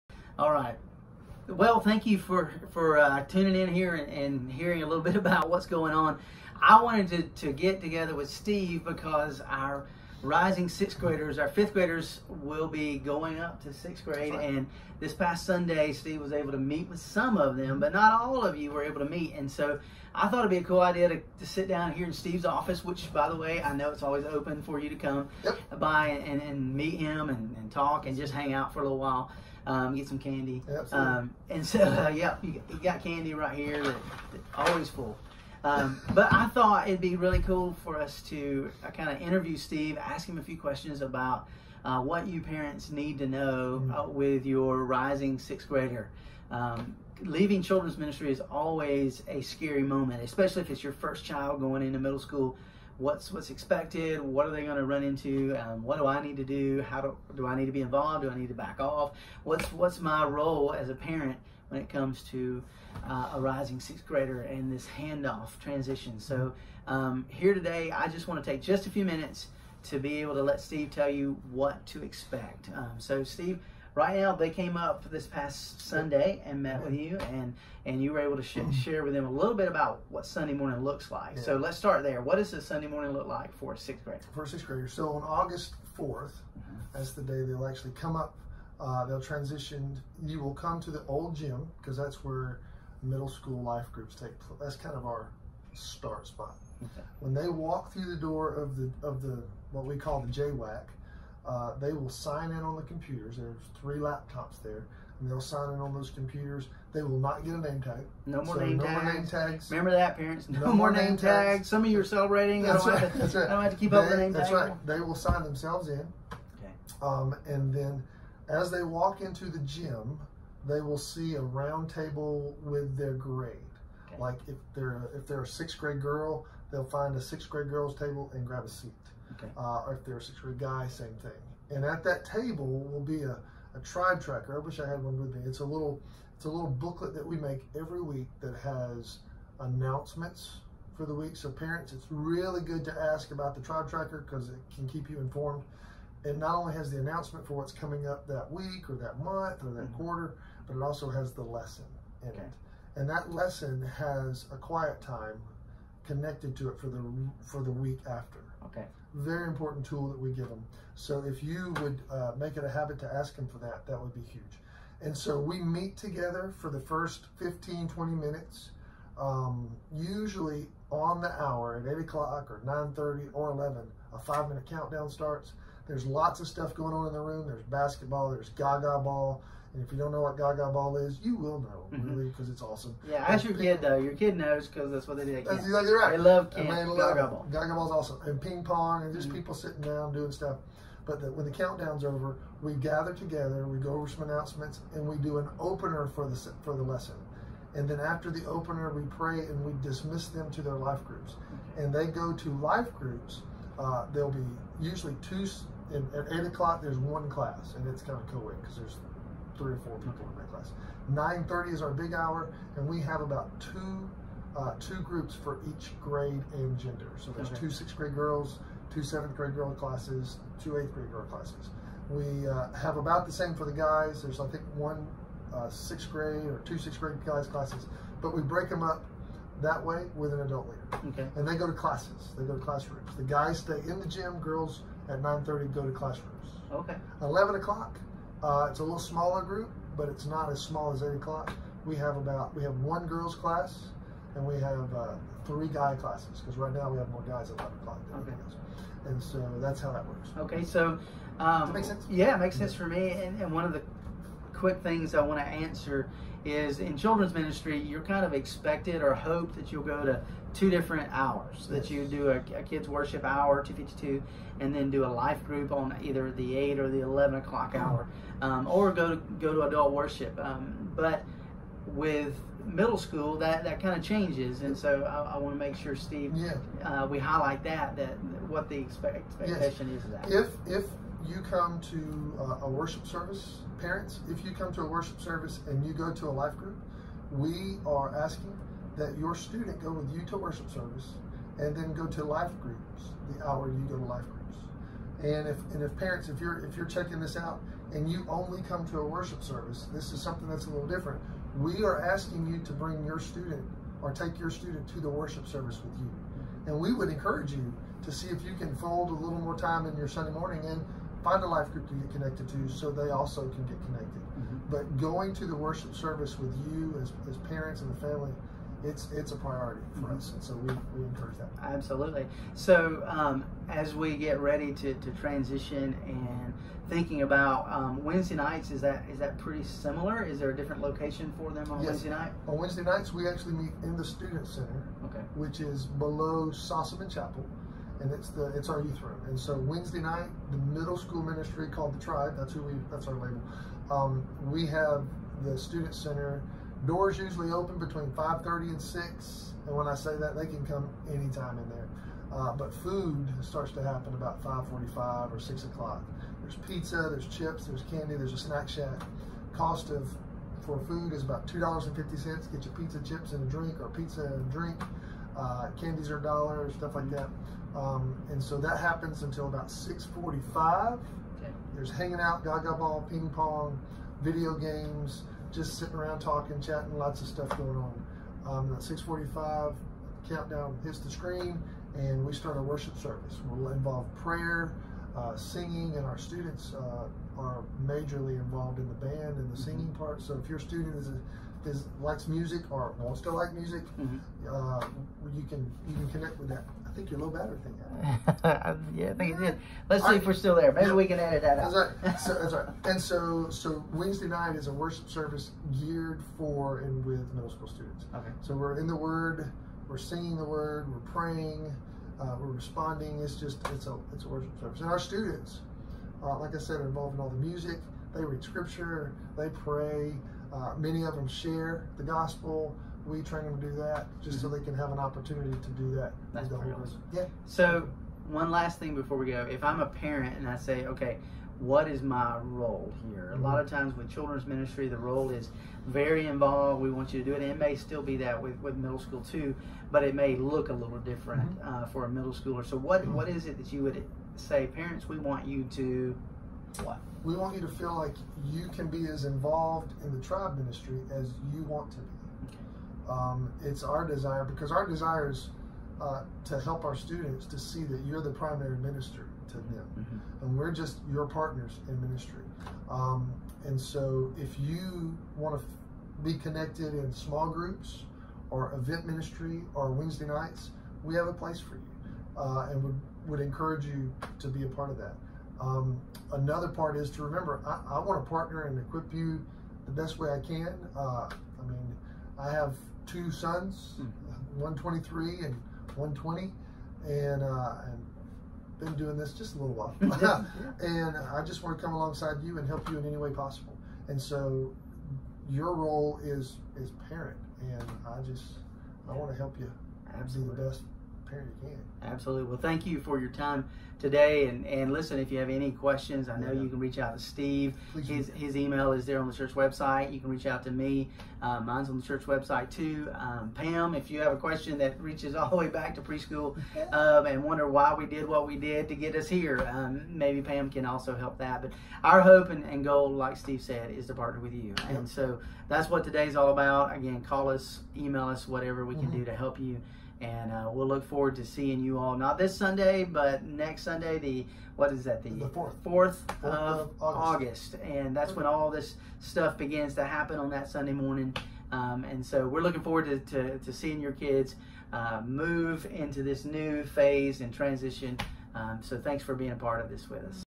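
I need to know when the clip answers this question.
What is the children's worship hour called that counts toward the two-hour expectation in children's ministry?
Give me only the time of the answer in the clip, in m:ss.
4:23.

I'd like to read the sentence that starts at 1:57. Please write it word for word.
Um, and then, as they walk into the gym, they will see a round table with their grade.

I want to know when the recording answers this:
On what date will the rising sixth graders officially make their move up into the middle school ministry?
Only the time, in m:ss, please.
1:25.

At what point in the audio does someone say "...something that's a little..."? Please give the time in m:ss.
5:00.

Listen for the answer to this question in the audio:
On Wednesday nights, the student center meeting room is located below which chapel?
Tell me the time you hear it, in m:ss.
5:36.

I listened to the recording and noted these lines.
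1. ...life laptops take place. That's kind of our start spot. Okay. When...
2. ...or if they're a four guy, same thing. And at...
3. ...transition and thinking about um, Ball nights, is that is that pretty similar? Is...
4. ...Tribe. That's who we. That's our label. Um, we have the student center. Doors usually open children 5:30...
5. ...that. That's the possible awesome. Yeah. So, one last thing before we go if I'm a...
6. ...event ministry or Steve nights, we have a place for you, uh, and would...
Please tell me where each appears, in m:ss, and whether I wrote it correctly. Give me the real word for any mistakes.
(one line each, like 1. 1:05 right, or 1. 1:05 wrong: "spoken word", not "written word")
1. 1:33 wrong: "groups", not "laptops"
2. 2:09 wrong: "six", not "four"
3. 5:25 wrong: "Wednesday", not "Ball"
4. 5:42 wrong: "between", not "children"
5. 7:05 wrong: "whole", not "possible"
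6. 7:48 wrong: "Wednesday", not "Steve".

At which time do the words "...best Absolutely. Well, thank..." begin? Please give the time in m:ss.
8:20.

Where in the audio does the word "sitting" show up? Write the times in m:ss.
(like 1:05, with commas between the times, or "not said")
3:09, 6:15.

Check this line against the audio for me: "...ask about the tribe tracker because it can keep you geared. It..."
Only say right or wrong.
wrong.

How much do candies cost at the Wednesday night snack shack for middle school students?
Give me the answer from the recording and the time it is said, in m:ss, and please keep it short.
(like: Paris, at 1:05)
A dollar, at 6:06.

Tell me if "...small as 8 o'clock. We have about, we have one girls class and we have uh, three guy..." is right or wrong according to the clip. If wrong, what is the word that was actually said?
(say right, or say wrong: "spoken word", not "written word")
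right.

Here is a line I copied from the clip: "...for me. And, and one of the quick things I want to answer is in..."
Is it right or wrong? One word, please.
right.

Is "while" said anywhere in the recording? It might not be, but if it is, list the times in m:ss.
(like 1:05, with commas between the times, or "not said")
0:28, 8:09.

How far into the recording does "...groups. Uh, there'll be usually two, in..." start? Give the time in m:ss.
3:23.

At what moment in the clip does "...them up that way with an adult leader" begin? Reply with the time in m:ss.
3:48.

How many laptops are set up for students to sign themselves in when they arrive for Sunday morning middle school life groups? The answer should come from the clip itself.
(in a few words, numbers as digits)
3.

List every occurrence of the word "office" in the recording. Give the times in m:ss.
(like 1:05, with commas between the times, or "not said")
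0:22.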